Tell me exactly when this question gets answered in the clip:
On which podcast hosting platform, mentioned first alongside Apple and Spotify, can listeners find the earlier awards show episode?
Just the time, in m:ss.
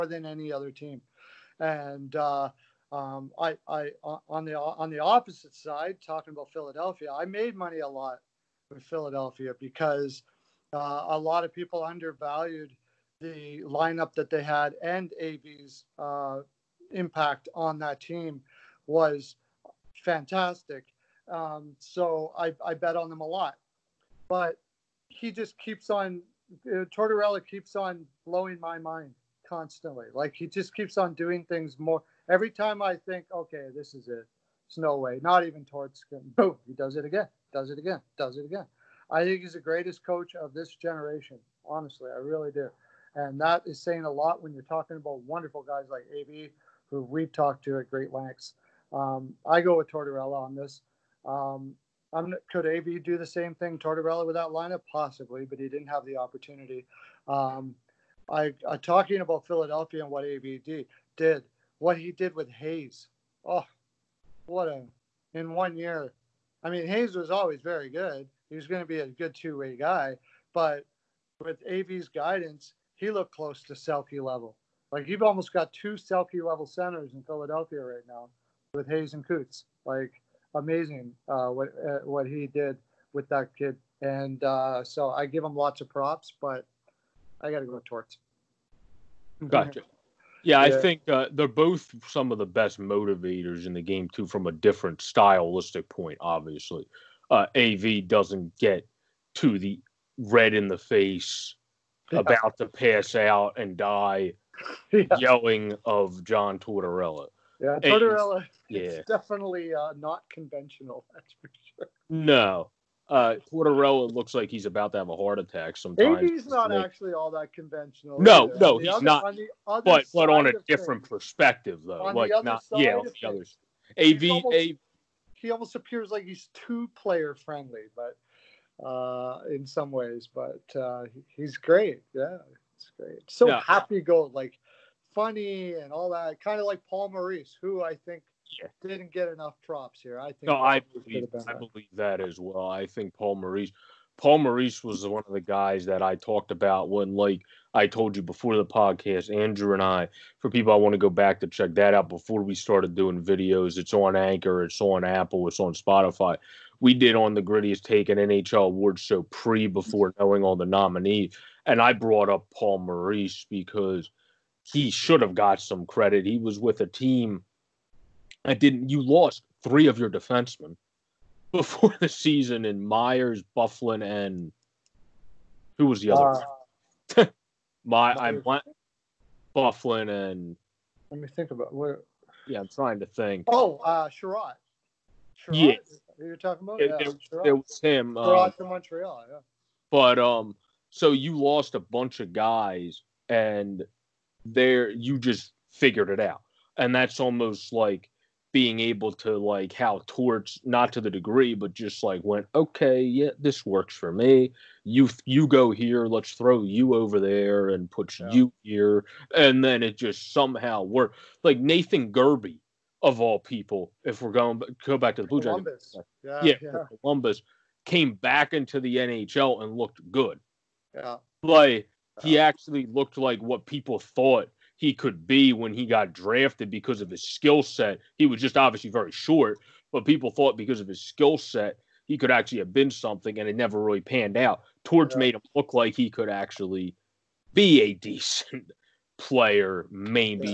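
2:33.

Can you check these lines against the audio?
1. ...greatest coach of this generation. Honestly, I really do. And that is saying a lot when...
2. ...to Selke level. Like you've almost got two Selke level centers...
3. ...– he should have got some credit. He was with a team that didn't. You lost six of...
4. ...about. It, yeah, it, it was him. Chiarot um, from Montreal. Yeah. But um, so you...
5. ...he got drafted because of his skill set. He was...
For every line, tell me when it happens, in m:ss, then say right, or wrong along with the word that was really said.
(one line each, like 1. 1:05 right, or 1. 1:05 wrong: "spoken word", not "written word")
1. 0:39 right
2. 1:13 right
3. 2:44 wrong: "three", not "six"
4. 3:06 right
5. 3:45 right.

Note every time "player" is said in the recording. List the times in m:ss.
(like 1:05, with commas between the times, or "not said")
2:06, 3:59.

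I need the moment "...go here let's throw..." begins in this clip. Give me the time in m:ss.
3:25.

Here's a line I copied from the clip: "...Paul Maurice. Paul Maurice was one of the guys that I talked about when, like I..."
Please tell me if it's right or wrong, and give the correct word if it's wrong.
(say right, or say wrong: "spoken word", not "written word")
right.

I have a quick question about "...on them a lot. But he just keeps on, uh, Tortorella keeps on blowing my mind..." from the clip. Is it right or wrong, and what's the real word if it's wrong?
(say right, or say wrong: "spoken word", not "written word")
right.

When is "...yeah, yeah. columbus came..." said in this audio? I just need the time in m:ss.
3:36.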